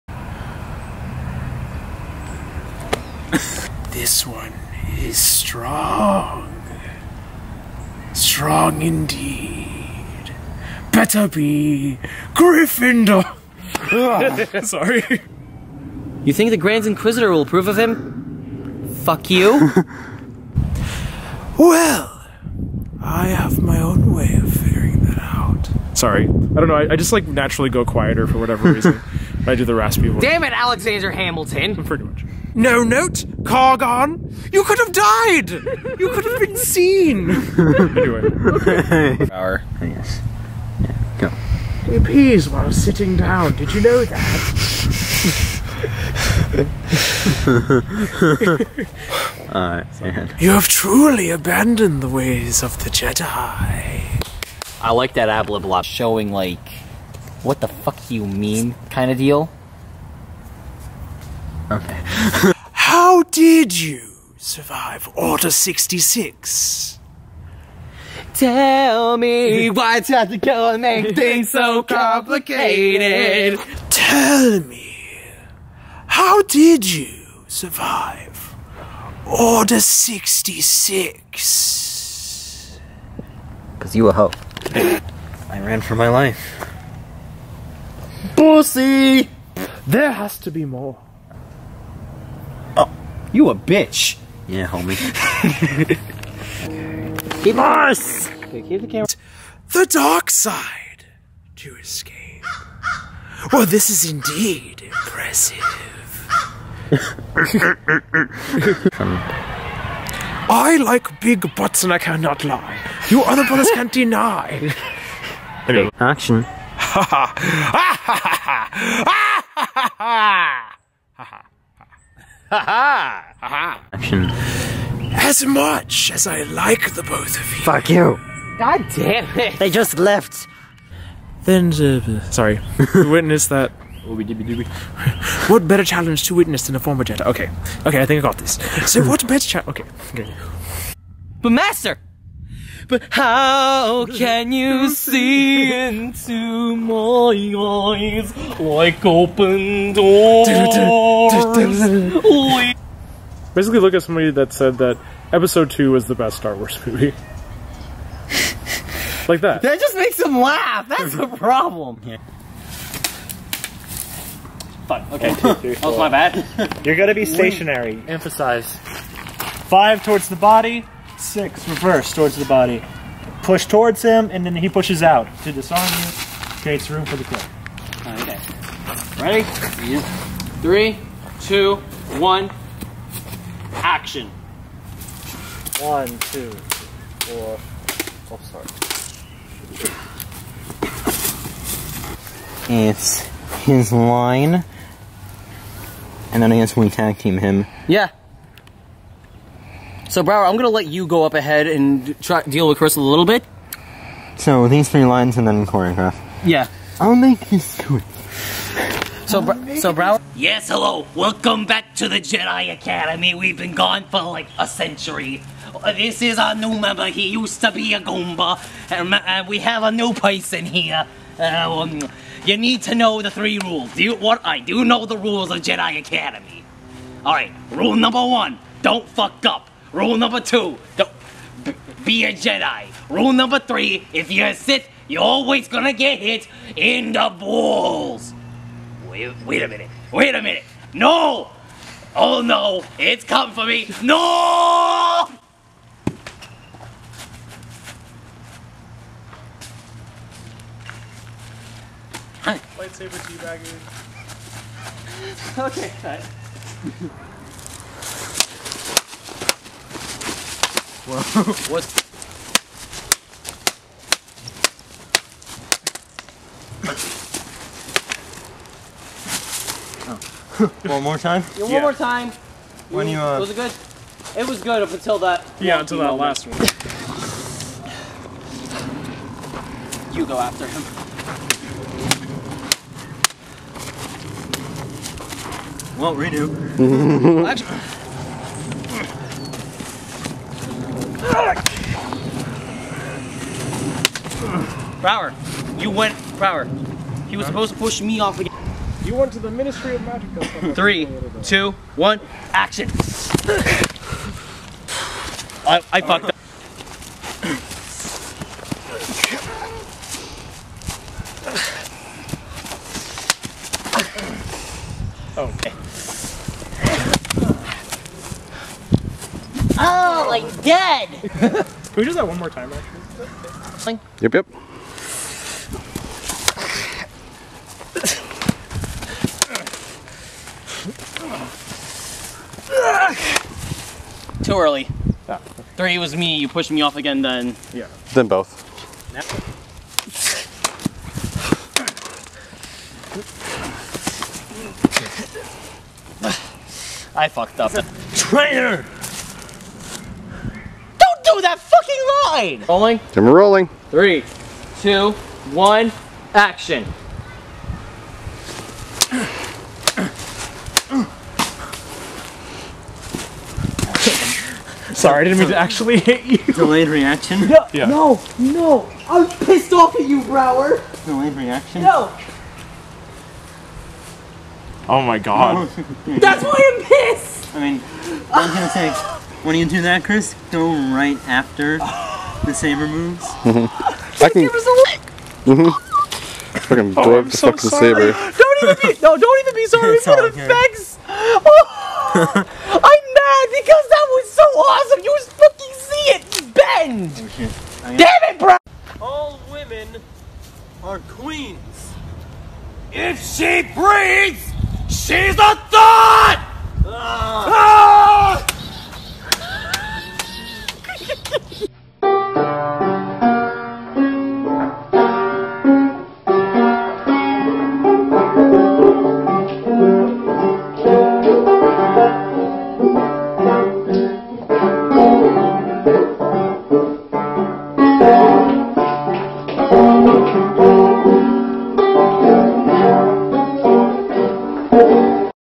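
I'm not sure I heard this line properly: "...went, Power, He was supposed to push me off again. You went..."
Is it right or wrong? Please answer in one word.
right.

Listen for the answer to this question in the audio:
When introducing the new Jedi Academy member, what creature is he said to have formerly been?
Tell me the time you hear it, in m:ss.
3:38.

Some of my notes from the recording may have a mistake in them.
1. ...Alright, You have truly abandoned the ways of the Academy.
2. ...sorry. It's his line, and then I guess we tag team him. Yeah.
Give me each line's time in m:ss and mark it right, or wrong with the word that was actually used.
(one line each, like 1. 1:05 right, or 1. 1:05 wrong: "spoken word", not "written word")
1. 0:49 wrong: "Jedi", not "Academy"
2. 3:08 right.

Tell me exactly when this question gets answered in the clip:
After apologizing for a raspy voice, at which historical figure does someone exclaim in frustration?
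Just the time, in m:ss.
0:30.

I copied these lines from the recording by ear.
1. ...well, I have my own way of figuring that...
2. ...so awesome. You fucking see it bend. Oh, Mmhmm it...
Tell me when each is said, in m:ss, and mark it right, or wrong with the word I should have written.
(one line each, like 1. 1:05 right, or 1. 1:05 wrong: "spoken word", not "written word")
1. 0:21 right
2. 6:34 wrong: "Damn", not "Mmhmm".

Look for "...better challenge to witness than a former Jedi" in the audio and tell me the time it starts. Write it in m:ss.
2:15.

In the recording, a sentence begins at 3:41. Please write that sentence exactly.
Uh, um, you need to know the three rules.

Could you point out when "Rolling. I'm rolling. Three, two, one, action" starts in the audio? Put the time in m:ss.
5:52.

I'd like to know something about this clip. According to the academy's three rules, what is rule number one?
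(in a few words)
Don't fuck up.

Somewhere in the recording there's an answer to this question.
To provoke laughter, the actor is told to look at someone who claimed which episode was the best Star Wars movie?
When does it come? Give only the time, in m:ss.
2:35.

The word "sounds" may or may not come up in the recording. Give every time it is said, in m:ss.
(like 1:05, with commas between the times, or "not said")
not said.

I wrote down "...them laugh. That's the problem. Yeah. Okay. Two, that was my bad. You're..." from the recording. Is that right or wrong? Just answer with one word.
right.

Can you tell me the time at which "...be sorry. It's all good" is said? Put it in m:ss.
6:29.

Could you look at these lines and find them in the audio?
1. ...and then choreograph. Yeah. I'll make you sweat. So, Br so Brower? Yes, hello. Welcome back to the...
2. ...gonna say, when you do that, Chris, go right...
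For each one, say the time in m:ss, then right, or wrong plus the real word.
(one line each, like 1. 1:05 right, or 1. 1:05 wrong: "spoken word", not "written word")
1. 3:25 right
2. 6:18 right.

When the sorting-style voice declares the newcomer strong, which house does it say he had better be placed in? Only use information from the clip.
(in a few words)
Gryffindor.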